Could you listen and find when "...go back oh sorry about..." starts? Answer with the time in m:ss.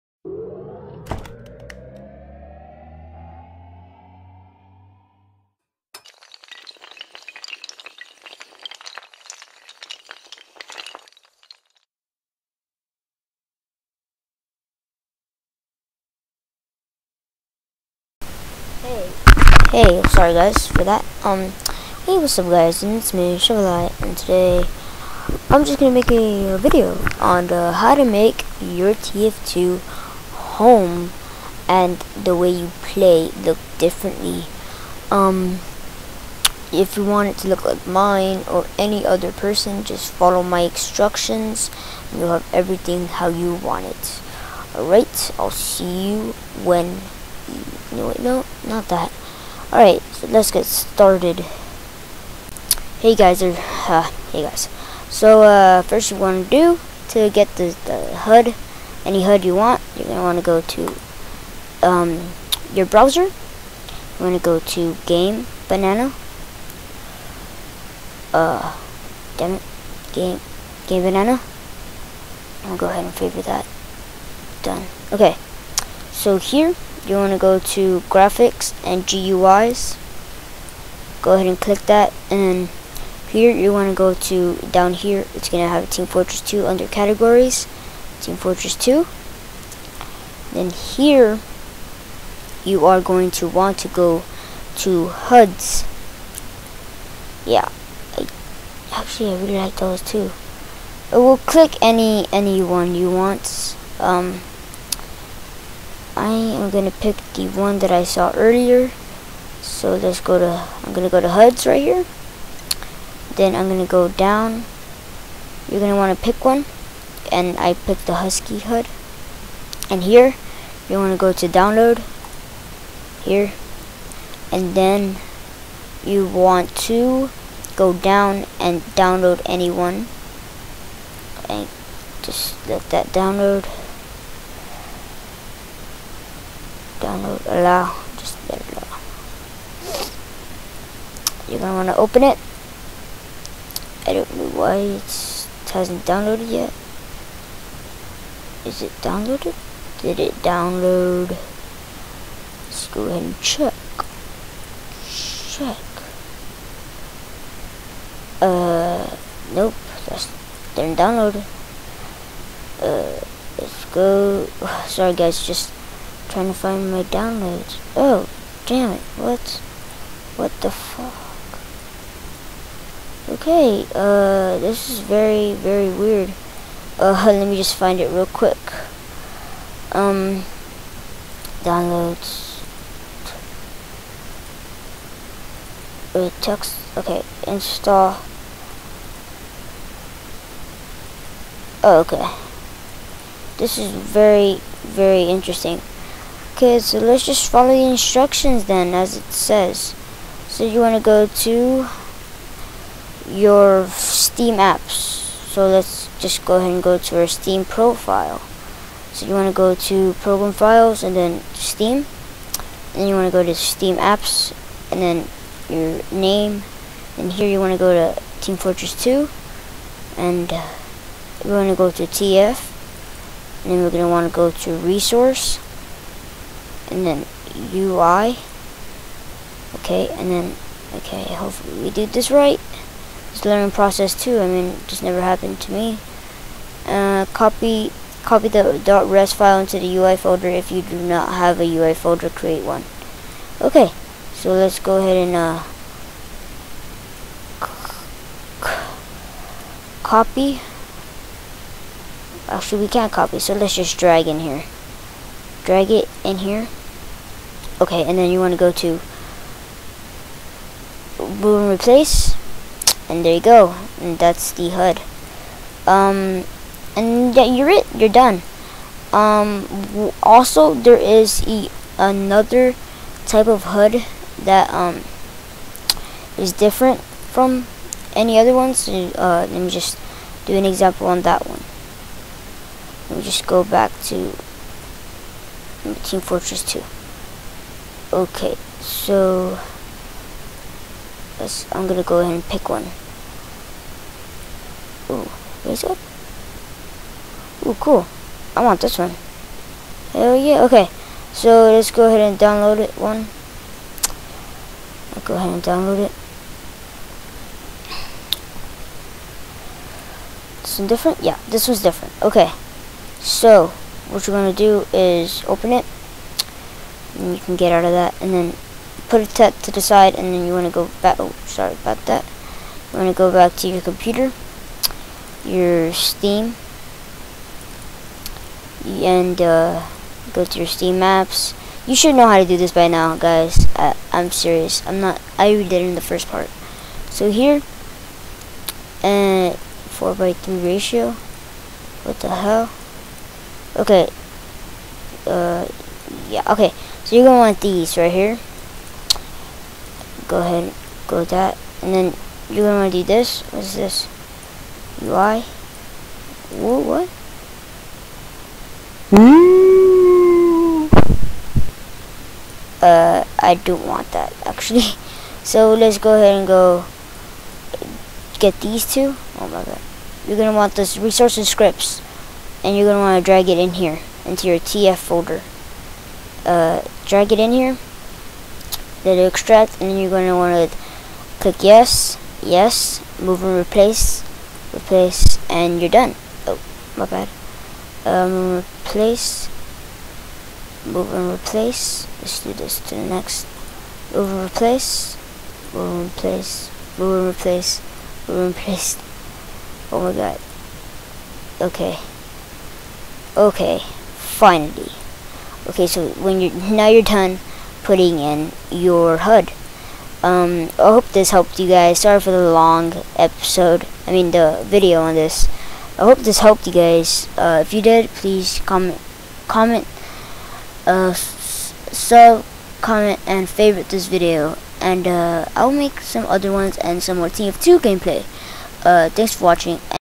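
5:20.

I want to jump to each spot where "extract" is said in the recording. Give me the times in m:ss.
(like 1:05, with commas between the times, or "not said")
6:19.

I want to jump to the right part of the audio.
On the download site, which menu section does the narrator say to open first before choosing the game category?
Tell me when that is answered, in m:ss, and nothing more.
1:18.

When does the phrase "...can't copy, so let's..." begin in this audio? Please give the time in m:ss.
4:12.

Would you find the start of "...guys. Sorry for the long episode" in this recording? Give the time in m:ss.
6:51.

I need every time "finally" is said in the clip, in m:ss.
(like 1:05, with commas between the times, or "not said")
6:44.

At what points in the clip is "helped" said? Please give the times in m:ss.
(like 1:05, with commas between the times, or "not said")
6:51, 6:56.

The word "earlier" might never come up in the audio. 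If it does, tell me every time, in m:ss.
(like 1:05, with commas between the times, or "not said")
1:48.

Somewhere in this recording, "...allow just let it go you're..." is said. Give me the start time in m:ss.
2:17.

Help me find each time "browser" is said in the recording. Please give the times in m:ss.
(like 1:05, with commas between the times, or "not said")
1:02.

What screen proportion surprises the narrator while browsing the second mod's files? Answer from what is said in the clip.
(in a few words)
4 by 3.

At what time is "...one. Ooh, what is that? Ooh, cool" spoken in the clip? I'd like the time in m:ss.
4:52.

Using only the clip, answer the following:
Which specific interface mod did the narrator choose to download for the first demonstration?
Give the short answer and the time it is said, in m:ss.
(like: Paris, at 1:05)
Husky HUD, at 1:58.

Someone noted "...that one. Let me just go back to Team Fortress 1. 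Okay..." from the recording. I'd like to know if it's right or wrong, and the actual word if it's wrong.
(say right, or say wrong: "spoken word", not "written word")
wrong: "2", not "1".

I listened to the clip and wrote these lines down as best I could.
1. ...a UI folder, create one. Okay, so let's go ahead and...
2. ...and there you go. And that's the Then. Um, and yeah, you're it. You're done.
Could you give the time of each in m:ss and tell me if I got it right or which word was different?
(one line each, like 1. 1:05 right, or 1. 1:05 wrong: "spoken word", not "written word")
1. 4:01 right
2. 4:23 wrong: "HUD", not "Then".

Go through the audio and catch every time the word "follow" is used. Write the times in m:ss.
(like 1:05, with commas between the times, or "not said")
0:40, 3:17.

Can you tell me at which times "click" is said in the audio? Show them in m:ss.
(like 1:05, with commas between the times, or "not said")
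1:21, 1:41, 6:21.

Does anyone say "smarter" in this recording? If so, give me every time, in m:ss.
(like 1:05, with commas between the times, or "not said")
not said.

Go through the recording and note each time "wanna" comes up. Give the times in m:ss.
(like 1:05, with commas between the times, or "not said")
5:52, 6:13.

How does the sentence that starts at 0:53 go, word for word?
Hey guys, or, uh, hey guys.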